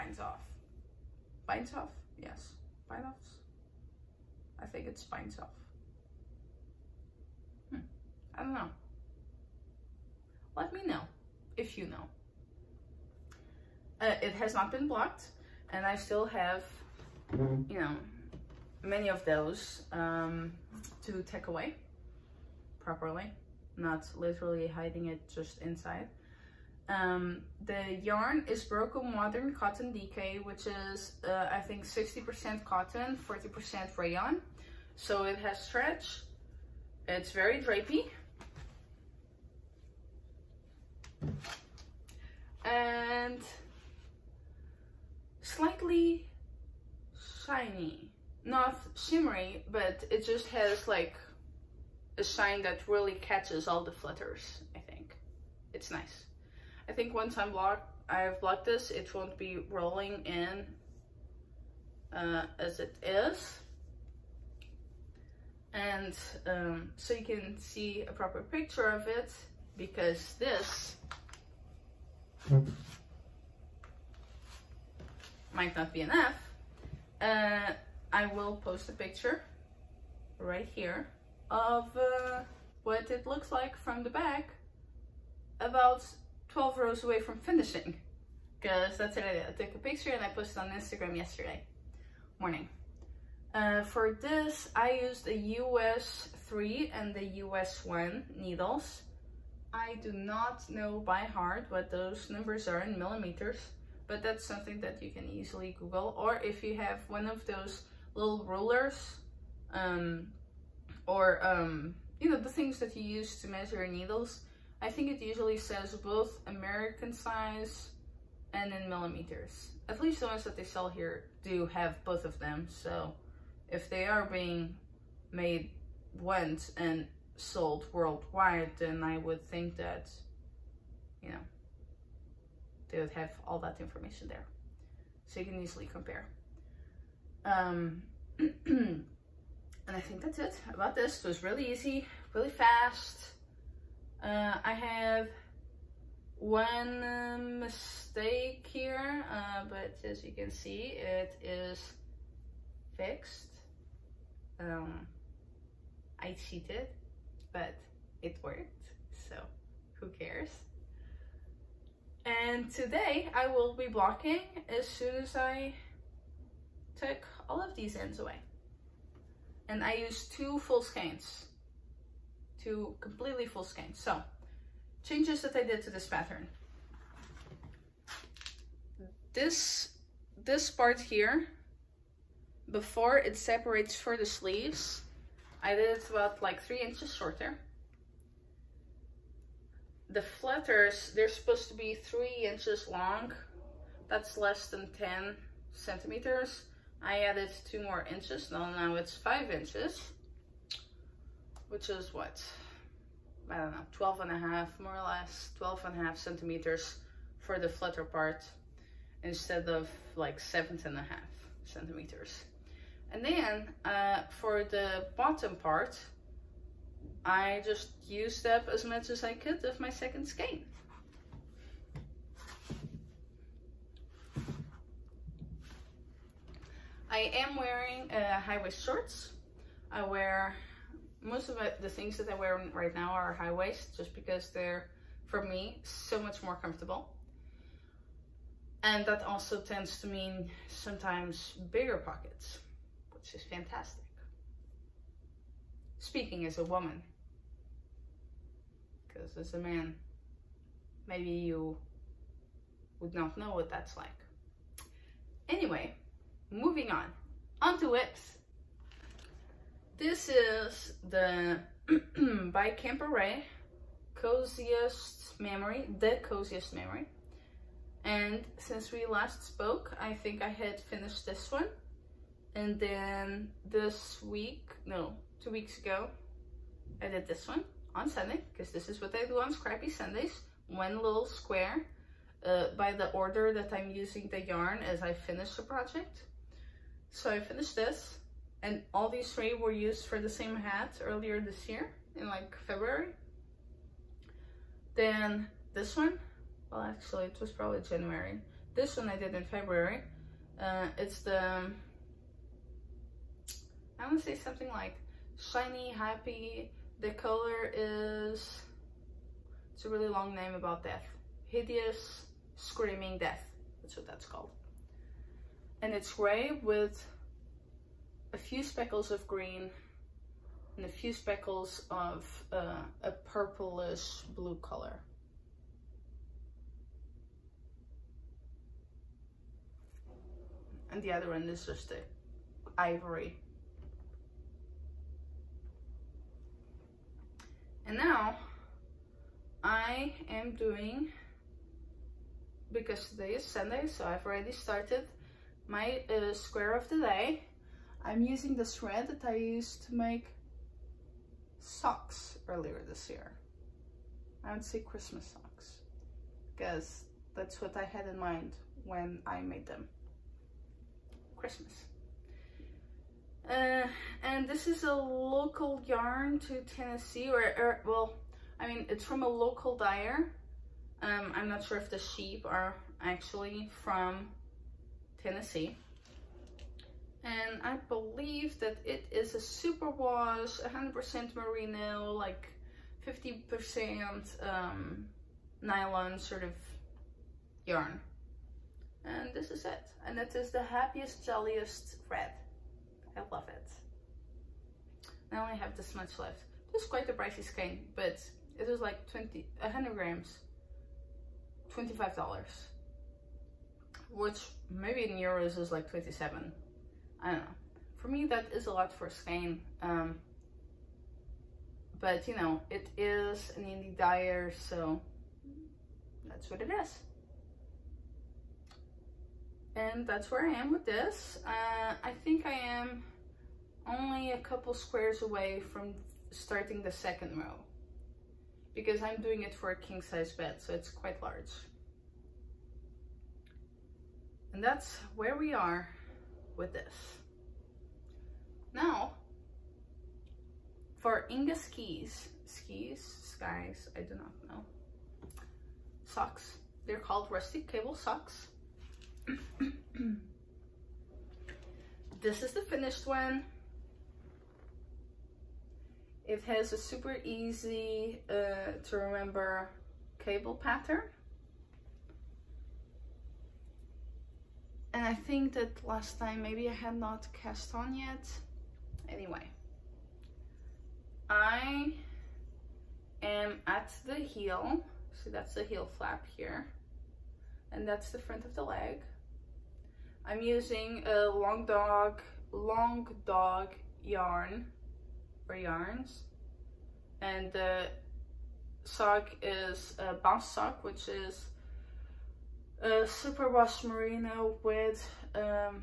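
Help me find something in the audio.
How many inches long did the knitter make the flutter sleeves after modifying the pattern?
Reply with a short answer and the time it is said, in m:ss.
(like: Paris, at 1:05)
5 inches, at 3:19.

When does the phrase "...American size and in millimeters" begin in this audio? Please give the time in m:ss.
1:56.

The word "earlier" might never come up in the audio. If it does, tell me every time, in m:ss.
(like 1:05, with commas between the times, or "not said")
4:51, 5:52.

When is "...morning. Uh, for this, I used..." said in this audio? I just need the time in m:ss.
1:32.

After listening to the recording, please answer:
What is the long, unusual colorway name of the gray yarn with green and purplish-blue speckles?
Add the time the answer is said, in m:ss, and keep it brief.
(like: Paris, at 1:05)
Hideous Screaming Death, at 5:11.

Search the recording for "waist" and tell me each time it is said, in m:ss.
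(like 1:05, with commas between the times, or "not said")
3:48, 3:53.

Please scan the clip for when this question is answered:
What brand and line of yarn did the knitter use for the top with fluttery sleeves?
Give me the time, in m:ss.
0:28.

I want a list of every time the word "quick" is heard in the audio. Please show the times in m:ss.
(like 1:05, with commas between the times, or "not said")
not said.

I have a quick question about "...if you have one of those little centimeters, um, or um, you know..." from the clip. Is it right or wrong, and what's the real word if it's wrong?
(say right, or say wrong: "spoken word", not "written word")
wrong: "rulers", not "centimeters".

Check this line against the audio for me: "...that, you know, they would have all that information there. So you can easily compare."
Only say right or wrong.
right.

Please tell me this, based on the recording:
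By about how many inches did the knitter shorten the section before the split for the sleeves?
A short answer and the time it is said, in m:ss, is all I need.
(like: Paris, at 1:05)
3 inches, at 3:06.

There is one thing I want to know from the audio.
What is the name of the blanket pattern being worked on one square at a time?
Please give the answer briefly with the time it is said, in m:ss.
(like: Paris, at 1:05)
The Coziest Memory, at 4:26.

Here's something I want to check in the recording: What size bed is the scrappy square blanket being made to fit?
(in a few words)
King size.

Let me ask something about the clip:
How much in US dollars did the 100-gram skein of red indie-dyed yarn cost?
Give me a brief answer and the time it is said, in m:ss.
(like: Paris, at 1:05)
$25, at 6:41.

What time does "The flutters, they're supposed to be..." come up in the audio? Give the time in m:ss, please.
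3:10.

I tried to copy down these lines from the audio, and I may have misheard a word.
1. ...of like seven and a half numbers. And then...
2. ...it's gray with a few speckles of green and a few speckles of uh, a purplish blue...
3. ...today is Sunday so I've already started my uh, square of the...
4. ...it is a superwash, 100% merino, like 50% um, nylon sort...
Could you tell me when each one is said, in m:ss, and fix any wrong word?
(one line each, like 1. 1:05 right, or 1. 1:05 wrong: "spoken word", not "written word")
1. 3:29 wrong: "centimeters", not "numbers"
2. 5:15 right
3. 5:43 right
4. 6:18 right.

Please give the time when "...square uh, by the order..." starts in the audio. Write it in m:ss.
4:41.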